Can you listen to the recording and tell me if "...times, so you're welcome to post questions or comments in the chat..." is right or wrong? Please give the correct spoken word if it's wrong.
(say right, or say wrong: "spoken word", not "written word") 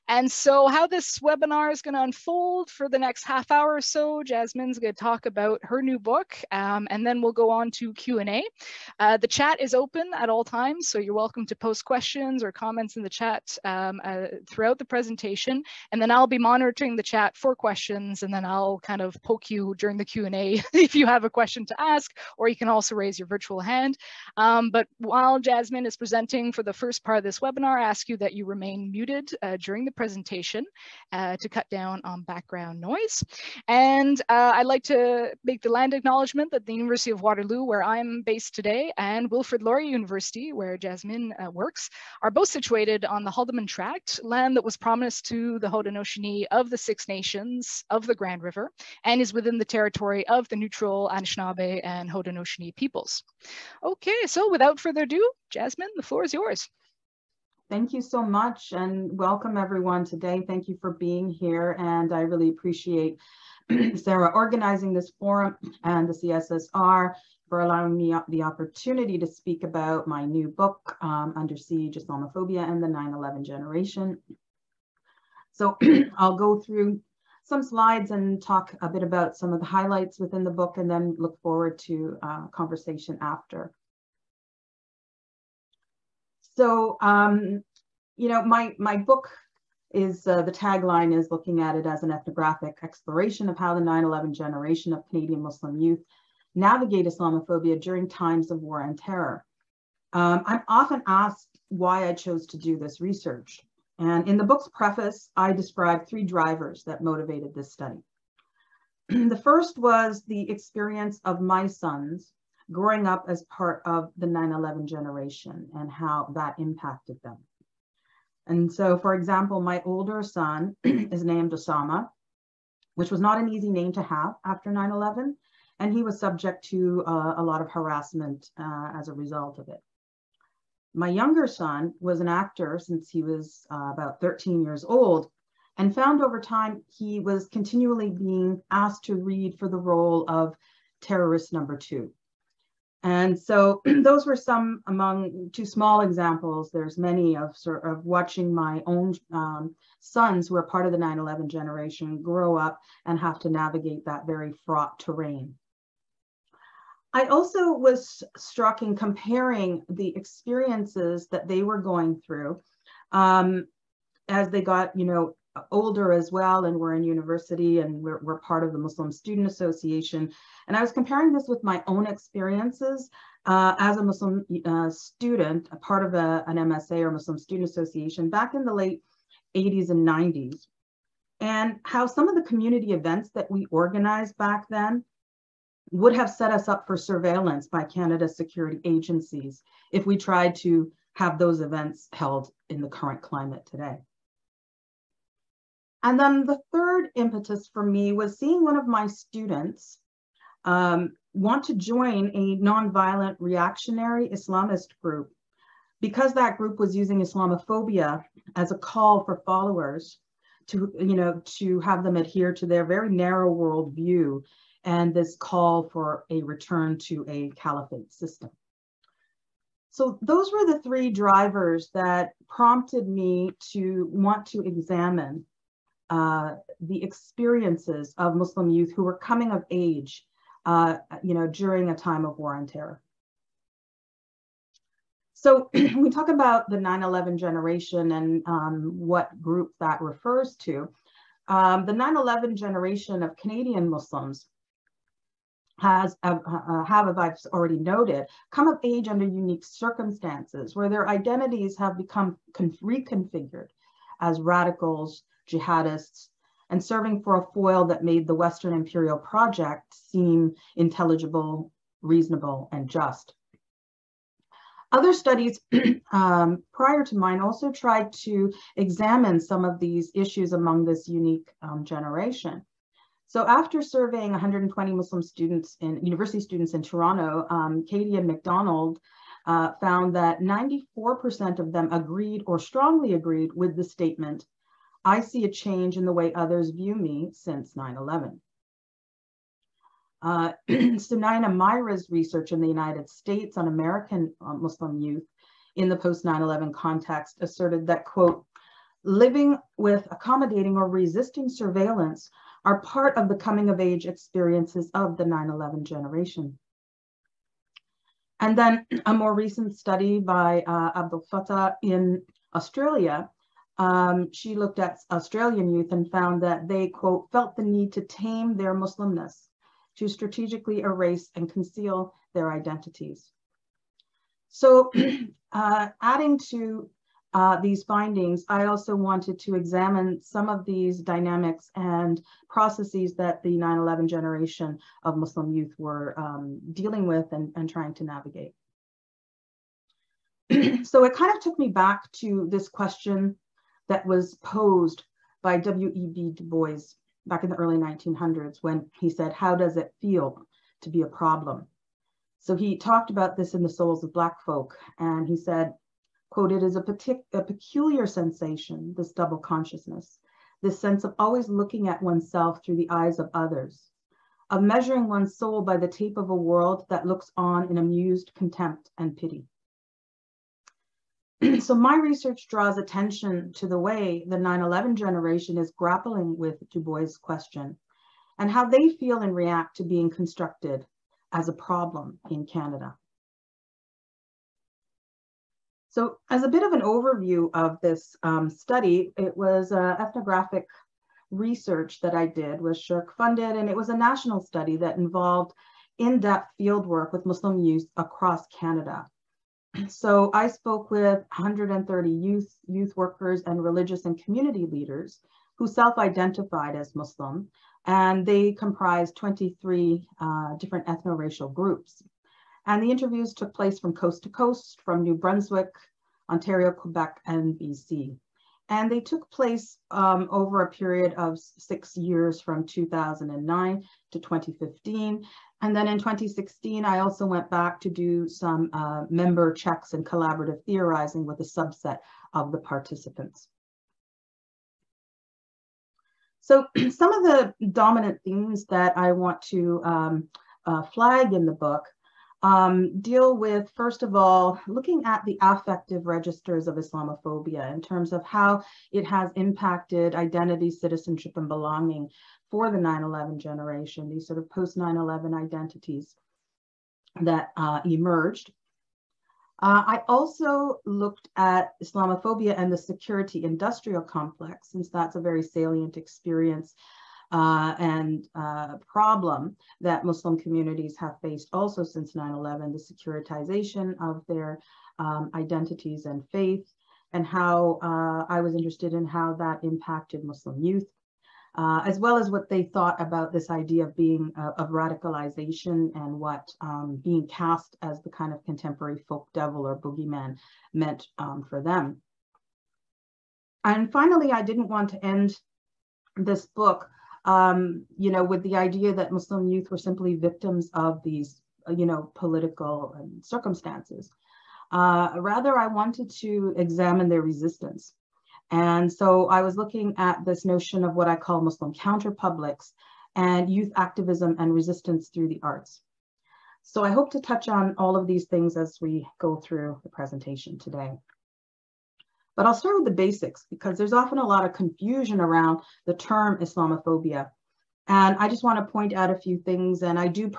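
right.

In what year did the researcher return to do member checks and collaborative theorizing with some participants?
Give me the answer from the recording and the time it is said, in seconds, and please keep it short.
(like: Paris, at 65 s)
2016, at 425 s.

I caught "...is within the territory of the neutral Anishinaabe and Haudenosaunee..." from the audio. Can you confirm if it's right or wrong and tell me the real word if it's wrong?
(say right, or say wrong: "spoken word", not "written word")
right.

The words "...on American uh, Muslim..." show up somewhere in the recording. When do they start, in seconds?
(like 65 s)
293 s.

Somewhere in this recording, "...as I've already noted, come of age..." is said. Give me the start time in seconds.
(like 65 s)
247 s.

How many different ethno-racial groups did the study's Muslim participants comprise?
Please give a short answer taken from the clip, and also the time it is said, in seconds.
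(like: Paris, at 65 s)
23, at 409 s.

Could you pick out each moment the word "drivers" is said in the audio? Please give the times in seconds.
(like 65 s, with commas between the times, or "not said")
106 s, 221 s.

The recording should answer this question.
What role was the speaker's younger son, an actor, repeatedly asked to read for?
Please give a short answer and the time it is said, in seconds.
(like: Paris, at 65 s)
terrorist number two, at 140 s.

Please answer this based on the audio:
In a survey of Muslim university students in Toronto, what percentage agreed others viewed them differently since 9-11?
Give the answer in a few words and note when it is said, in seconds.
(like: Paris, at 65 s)
94%, at 280 s.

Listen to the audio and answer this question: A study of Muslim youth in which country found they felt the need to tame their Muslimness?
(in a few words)
Australia.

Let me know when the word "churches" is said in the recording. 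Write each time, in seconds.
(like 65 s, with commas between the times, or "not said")
not said.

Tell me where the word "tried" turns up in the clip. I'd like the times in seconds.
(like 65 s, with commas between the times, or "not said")
190 s, 267 s.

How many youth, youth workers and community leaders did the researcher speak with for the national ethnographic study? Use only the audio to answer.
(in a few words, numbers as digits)
130.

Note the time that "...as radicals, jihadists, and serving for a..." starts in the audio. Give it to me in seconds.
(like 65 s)
254 s.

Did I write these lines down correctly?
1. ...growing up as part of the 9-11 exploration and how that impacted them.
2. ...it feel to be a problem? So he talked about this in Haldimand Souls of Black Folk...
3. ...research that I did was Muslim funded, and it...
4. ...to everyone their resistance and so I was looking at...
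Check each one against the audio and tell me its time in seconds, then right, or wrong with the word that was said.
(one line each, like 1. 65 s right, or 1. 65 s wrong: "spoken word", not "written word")
1. 112 s wrong: "generation", not "exploration"
2. 349 s wrong: "The", not "Haldimand"
3. 391 s wrong: "Shirk", not "Muslim"
4. 506 s wrong: "examine", not "everyone".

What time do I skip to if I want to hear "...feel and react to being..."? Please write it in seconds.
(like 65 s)
378 s.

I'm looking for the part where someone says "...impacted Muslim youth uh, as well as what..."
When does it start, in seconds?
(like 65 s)
479 s.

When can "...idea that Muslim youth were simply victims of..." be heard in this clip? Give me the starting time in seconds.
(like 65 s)
498 s.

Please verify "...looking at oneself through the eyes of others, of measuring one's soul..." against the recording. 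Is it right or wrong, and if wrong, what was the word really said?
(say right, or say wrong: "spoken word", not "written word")
right.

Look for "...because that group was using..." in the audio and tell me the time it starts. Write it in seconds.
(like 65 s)
205 s.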